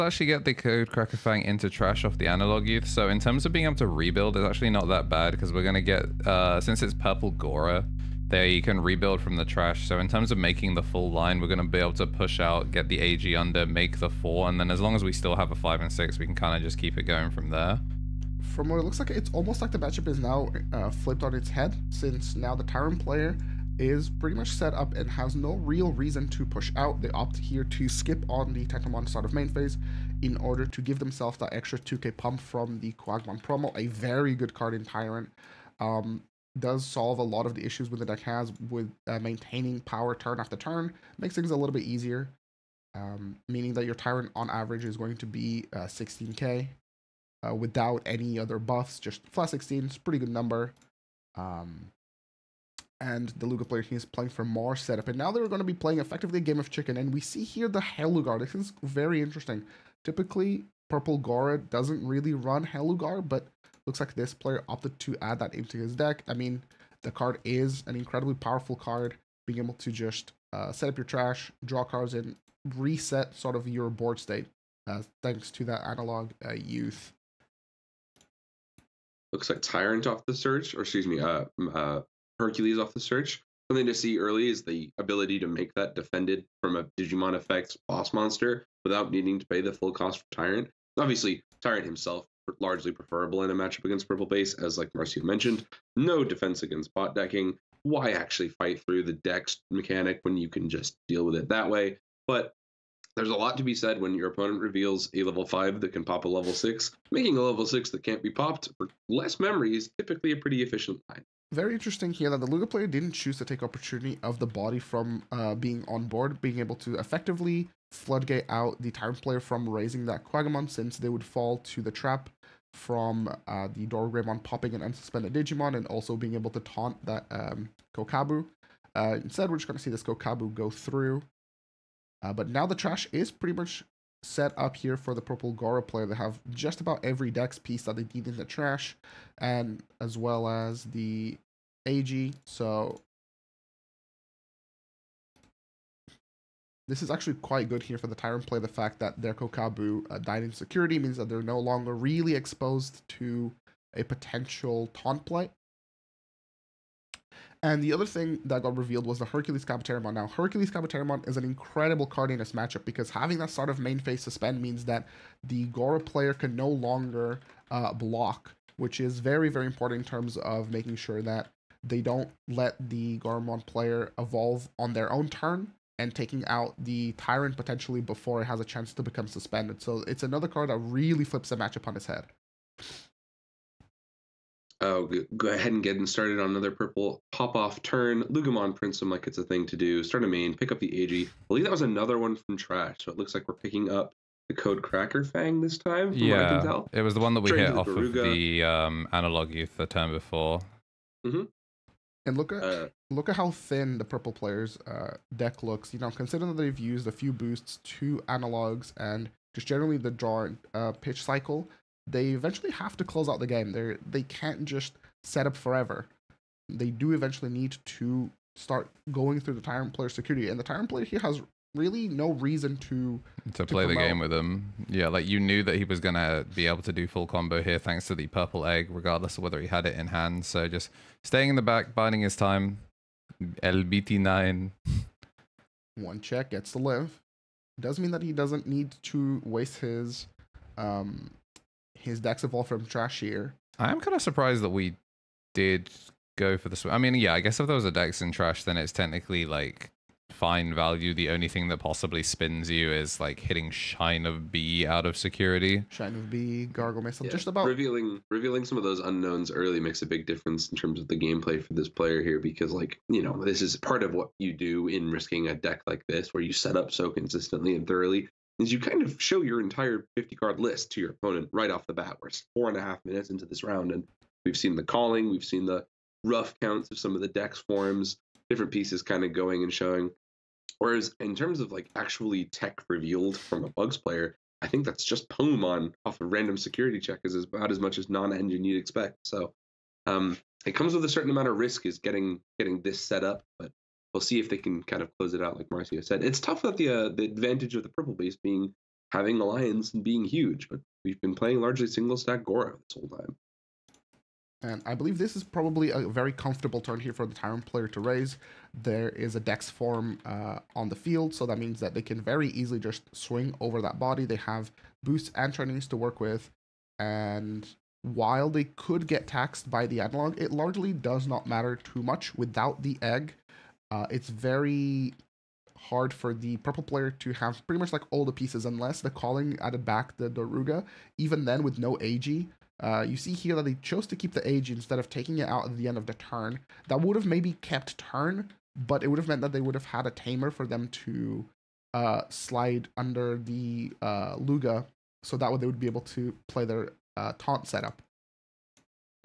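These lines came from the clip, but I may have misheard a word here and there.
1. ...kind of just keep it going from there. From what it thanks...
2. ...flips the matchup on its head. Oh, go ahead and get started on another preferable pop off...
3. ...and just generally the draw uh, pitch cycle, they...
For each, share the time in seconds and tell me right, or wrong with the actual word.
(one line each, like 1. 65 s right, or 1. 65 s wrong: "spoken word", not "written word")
1. 16 s wrong: "looks", not "thanks"
2. 181 s wrong: "purple", not "preferable"
3. 208 s right.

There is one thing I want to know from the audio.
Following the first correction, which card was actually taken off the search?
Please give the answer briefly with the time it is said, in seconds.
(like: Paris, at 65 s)
Hercules, at 82 s.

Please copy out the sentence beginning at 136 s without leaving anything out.
They have just about every dex piece that they need in the trash, and as well as the AG.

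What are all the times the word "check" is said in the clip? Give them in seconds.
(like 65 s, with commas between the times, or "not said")
236 s, 286 s.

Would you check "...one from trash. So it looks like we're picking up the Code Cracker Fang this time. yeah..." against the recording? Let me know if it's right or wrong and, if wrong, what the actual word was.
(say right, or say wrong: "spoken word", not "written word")
right.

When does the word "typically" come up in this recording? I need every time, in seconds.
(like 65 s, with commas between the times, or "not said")
60 s, 109 s.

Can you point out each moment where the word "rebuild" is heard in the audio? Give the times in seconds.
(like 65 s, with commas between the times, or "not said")
3 s, 8 s.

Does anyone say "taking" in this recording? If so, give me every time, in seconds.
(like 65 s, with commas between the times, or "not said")
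176 s, 335 s.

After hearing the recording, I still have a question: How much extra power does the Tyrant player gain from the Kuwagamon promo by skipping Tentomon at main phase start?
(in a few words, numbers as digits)
2k.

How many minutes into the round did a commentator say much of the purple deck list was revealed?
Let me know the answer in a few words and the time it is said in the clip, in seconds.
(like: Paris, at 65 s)
4.5, at 272 s.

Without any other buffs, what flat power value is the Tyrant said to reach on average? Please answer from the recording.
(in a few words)
16k.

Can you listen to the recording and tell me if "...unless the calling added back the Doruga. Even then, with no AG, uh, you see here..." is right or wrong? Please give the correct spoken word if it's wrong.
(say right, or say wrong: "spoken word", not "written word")
right.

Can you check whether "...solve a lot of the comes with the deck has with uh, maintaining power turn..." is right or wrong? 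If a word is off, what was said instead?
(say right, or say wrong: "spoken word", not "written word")
wrong: "issues", not "comes".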